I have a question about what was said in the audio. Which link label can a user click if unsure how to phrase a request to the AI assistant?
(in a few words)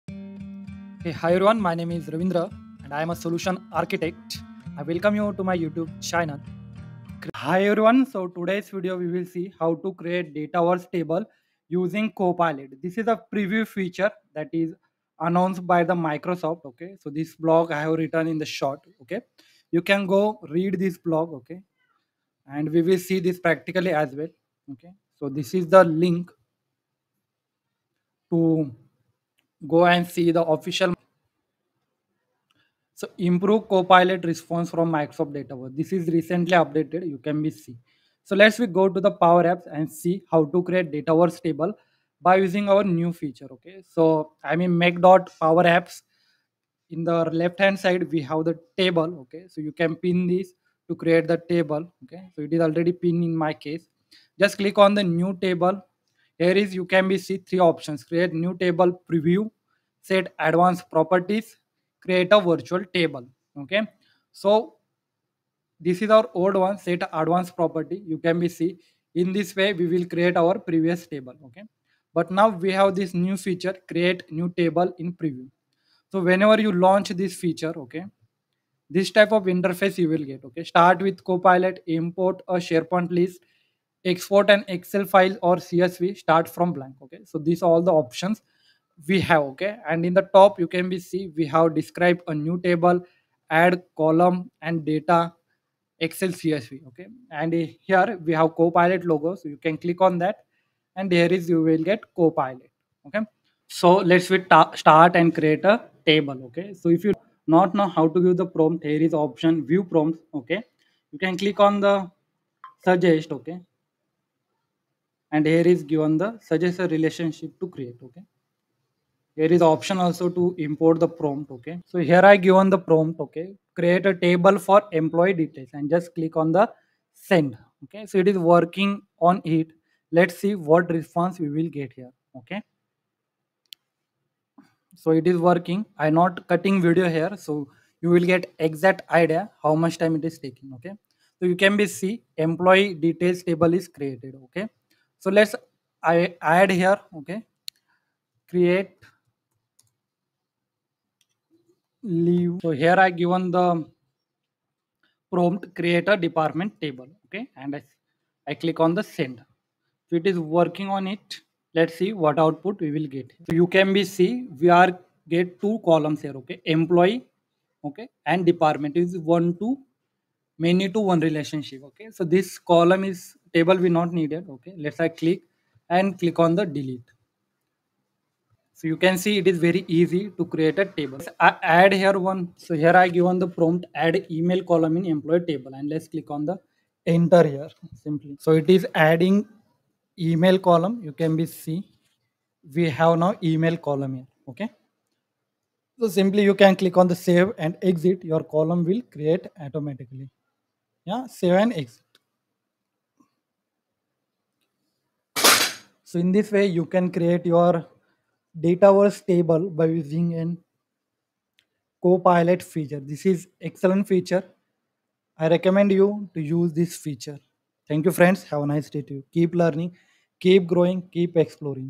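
View prompts.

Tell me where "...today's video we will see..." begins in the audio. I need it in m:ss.
0:08.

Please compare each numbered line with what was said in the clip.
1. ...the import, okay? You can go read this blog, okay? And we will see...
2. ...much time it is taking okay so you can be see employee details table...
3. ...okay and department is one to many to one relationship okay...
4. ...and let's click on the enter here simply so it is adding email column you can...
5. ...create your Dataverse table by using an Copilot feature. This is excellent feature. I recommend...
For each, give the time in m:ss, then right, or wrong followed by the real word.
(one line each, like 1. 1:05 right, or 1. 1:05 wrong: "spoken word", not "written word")
1. 0:18 wrong: "short", not "import"
2. 2:19 right
3. 2:47 right
4. 3:05 right
5. 3:27 right.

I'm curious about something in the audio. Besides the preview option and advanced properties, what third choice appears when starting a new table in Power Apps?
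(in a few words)
Create a virtual table.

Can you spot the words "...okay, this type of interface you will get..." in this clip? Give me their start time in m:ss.
1:17.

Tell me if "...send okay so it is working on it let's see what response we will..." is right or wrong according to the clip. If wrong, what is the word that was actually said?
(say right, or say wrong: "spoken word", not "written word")
right.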